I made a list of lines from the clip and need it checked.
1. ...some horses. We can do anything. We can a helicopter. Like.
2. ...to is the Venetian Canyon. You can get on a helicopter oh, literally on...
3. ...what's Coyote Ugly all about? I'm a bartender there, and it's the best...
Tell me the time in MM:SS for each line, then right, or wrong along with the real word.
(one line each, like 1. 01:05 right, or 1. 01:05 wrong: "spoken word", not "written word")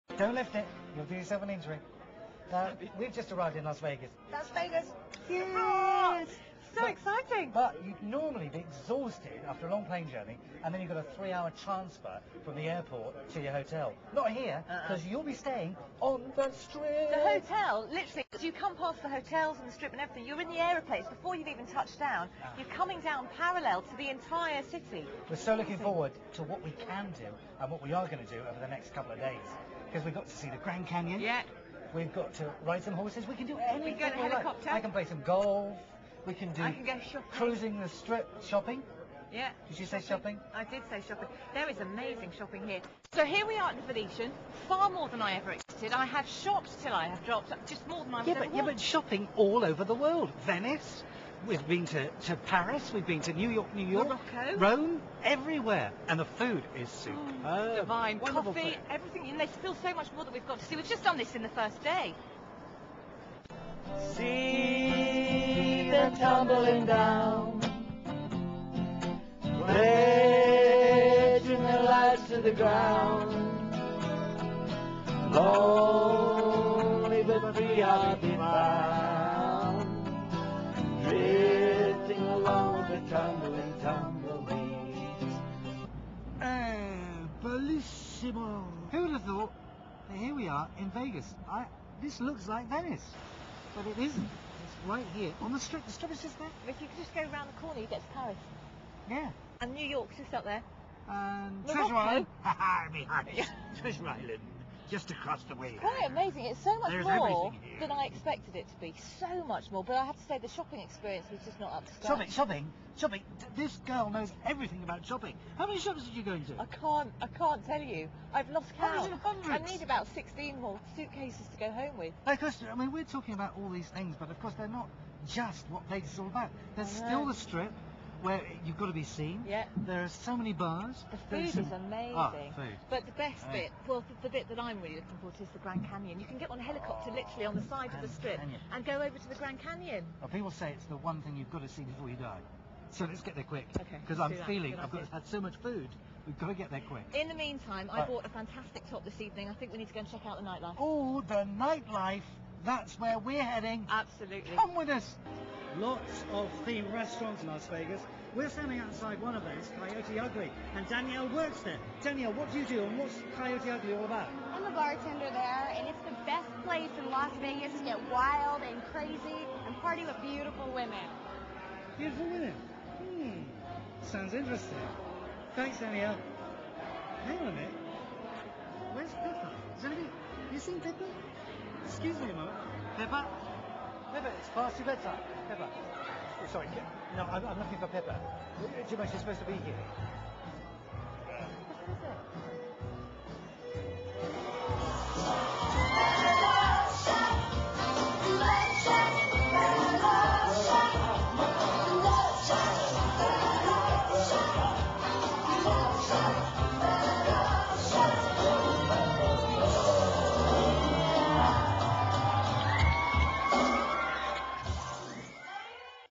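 1. 00:32 right
2. 02:15 wrong: "Grand", not "Venetian"
3. 02:42 right.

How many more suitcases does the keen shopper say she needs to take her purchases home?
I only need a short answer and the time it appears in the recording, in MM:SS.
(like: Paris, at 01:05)
16, at 02:00.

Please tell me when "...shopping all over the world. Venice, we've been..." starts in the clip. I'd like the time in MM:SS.
00:48.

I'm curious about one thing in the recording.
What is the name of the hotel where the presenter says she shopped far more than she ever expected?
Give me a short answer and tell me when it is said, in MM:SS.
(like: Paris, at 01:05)
The Venetian, at 00:43.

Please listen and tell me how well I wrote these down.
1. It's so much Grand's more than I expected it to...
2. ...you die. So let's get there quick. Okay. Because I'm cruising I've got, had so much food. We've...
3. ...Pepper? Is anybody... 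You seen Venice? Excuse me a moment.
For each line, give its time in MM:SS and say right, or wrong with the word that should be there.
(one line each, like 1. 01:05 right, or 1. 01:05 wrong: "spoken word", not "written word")
1. 01:46 wrong: "There", not "Grand"
2. 02:22 wrong: "feeling", not "cruising"
3. 02:59 wrong: "Pepper", not "Venice".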